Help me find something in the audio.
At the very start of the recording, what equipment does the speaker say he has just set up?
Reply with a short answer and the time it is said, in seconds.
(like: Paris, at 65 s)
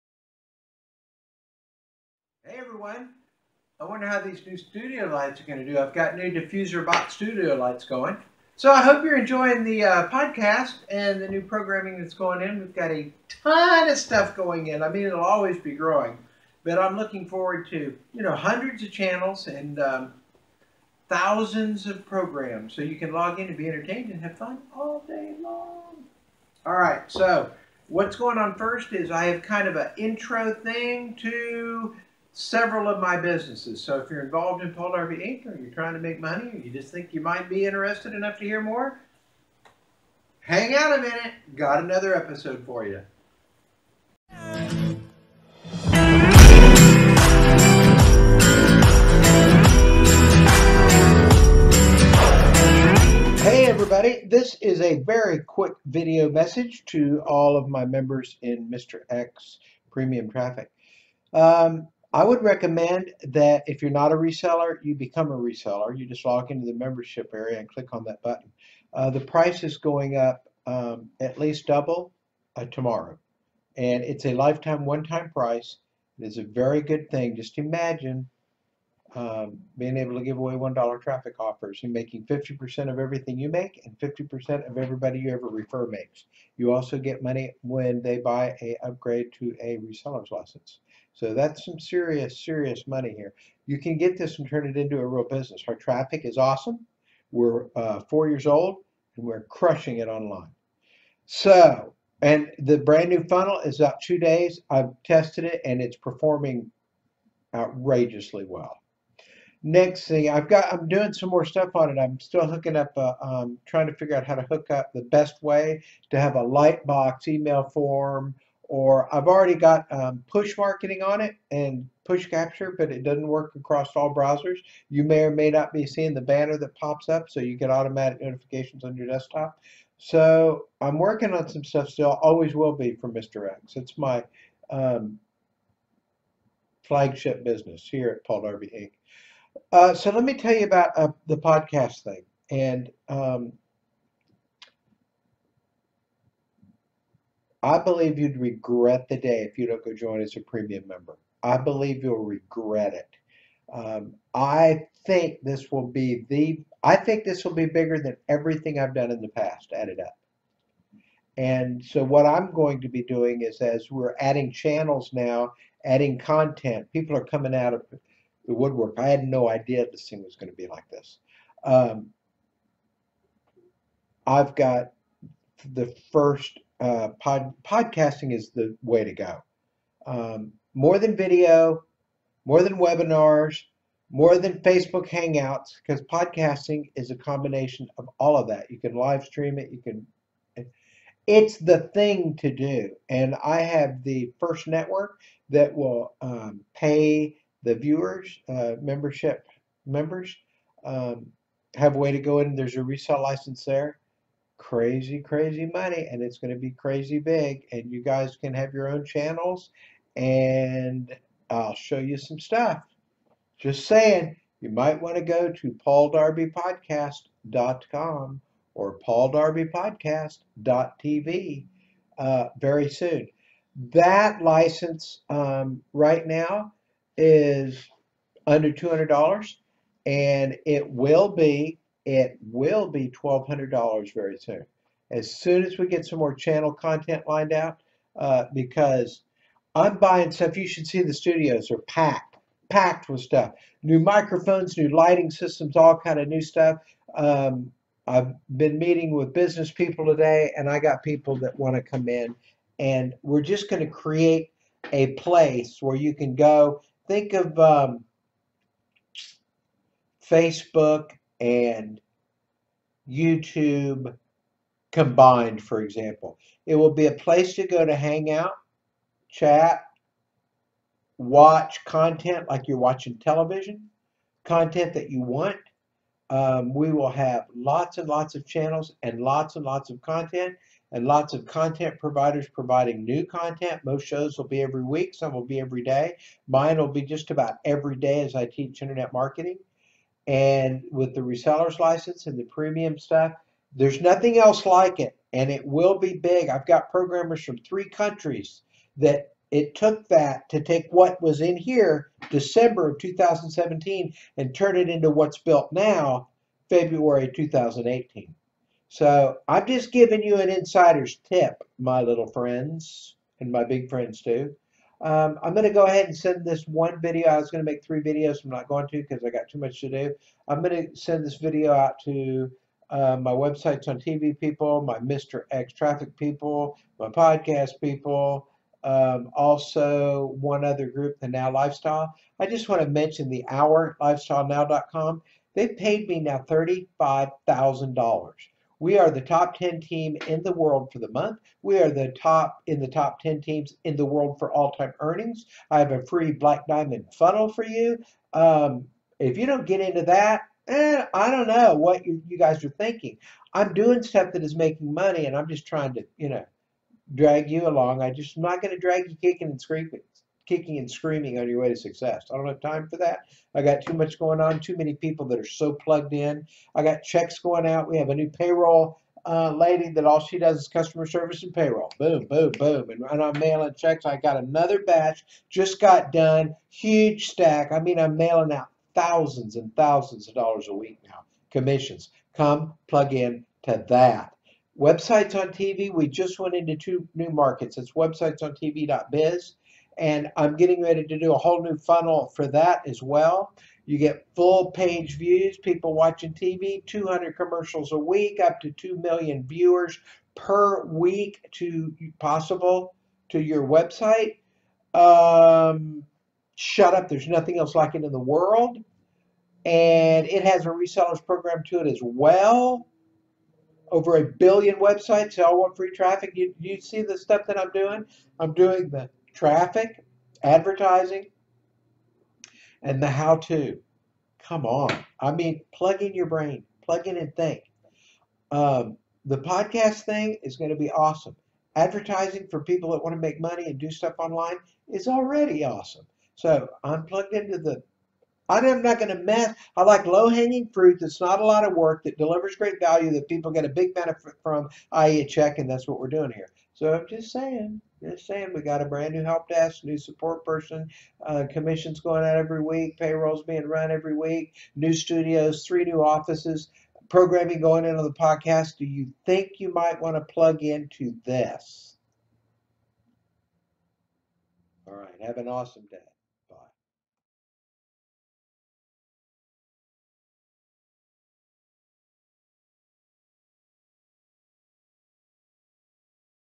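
diffuser box studio lights, at 6 s.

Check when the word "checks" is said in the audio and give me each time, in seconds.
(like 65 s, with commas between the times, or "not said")
367 s, 373 s, 445 s.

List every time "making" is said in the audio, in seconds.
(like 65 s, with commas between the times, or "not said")
81 s, 354 s.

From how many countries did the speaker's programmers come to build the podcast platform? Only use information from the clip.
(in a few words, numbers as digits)
3.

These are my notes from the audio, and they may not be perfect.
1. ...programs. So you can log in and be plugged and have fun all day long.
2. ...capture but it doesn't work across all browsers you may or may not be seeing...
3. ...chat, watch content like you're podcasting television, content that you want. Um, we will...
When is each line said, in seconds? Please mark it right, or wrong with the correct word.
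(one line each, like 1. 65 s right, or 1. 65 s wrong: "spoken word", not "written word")
1. 22 s wrong: "entertained", not "plugged"
2. 122 s right
3. 269 s wrong: "watching", not "podcasting".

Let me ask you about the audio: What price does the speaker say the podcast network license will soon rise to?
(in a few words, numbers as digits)
$1,200.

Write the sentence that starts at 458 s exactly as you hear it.
Do you think you might want to plug into this?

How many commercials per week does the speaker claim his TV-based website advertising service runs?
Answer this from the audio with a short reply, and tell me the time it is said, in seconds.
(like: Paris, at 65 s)
200, at 396 s.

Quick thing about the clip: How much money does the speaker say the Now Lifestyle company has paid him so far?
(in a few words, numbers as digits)
$35,000.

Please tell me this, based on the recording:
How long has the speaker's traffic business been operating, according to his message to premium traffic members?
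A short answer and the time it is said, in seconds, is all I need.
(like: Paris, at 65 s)
4 years, at 98 s.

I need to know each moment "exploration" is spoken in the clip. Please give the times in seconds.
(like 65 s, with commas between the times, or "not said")
not said.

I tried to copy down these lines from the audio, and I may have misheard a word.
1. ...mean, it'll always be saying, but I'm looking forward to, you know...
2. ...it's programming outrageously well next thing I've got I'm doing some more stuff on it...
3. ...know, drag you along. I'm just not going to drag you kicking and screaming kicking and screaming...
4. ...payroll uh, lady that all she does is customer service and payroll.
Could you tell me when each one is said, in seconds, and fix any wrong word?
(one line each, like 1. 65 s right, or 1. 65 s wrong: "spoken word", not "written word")
1. 14 s wrong: "growing", not "saying"
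2. 105 s wrong: "performing", not "programming"
3. 356 s right
4. 368 s right.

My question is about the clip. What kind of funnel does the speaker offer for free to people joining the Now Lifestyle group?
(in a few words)
Black Diamond funnel.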